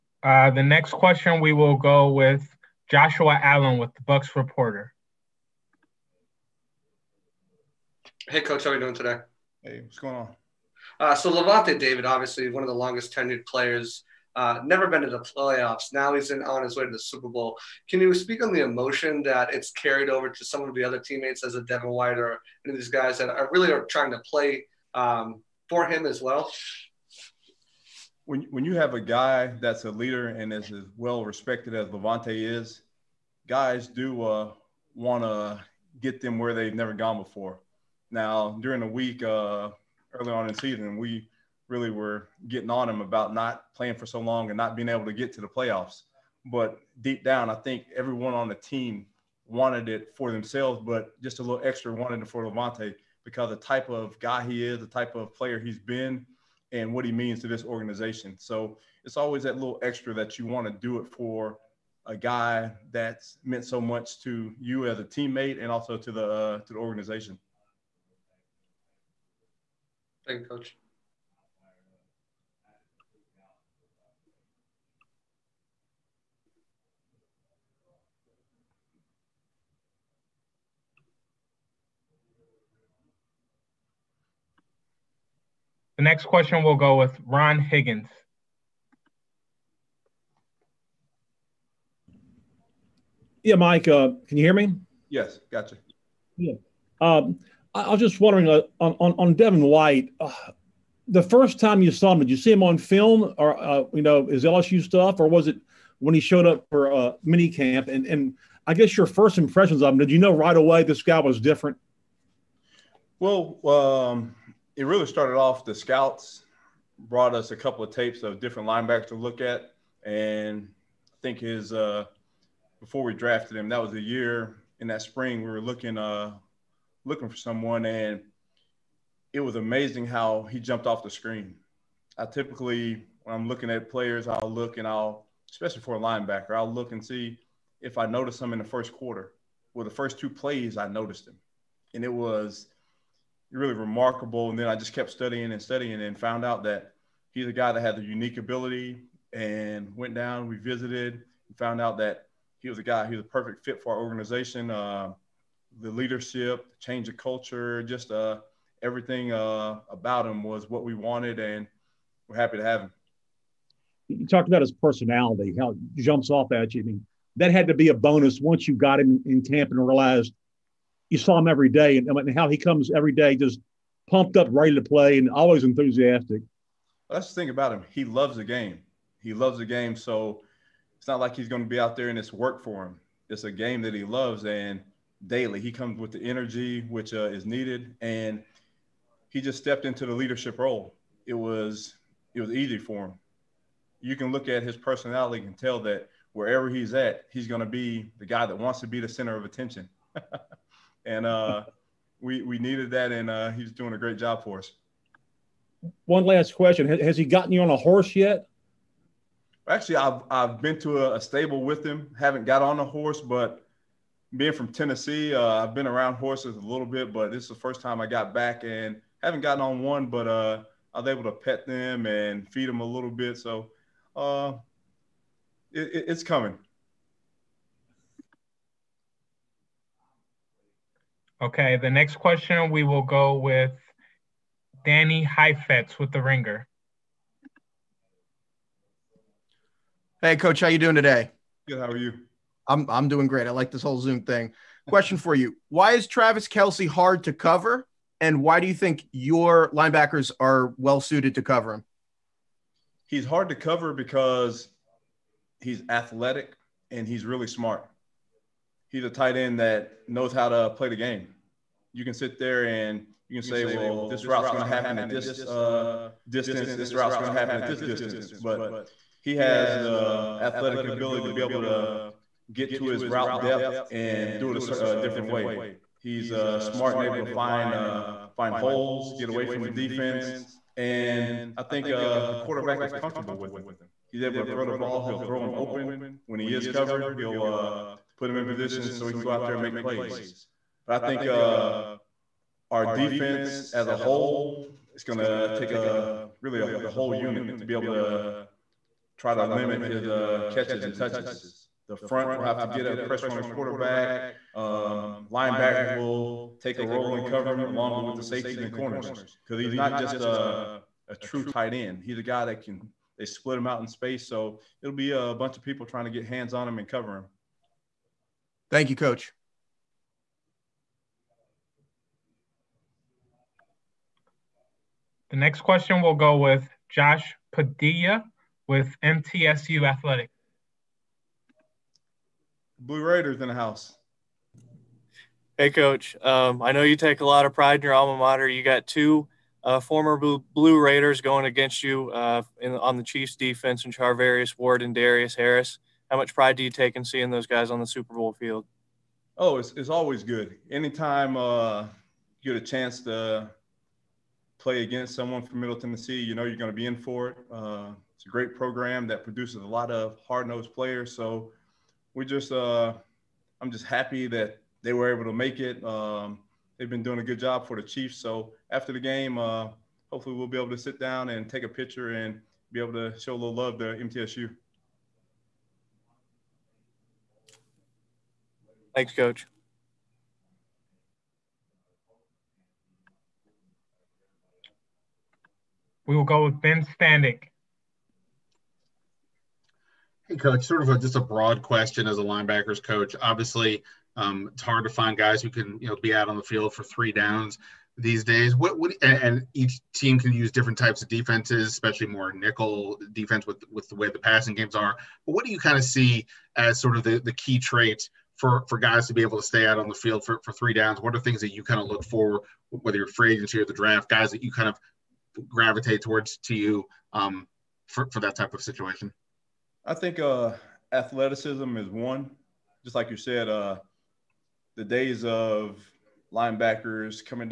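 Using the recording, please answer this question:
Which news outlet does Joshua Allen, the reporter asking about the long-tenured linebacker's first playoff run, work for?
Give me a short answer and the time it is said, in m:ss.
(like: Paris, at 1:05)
Bucs Reporter, at 0:04.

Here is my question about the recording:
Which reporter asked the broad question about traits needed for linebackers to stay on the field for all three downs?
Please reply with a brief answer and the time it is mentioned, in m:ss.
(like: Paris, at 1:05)
Ben Standig, at 6:26.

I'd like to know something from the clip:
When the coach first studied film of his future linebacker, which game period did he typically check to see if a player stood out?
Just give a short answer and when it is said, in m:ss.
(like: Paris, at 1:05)
first quarter, at 2:18.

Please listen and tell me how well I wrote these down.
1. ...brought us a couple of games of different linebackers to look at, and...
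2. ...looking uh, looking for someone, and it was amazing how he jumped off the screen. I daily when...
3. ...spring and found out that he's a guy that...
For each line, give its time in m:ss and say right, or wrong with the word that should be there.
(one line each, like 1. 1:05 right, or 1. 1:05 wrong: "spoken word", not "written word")
1. 1:56 wrong: "tapes", not "games"
2. 2:05 wrong: "typically", not "daily"
3. 2:25 wrong: "studying", not "spring".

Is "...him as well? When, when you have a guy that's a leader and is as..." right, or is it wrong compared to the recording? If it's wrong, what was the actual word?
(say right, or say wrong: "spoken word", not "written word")
right.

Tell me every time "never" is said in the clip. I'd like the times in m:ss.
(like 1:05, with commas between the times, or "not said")
0:14, 0:36.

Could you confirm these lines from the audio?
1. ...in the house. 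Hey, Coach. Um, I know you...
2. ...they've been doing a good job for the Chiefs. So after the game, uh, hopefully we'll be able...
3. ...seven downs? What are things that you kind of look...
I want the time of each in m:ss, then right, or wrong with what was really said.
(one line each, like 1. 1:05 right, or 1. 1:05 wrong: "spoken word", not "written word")
1. 5:33 right
2. 6:06 right
3. 6:50 wrong: "three", not "seven".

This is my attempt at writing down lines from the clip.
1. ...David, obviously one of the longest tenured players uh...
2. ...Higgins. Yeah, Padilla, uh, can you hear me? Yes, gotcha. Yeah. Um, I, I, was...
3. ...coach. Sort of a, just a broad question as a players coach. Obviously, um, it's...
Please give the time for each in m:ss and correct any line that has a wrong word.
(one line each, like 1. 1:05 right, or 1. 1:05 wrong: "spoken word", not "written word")
1. 0:11 right
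2. 1:27 wrong: "Mike", not "Padilla"
3. 6:30 wrong: "linebackers", not "players".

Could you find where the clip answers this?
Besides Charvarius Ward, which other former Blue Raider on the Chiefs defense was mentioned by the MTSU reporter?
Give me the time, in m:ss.
5:44.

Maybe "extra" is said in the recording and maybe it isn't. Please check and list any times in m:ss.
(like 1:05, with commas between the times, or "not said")
0:51, 0:59.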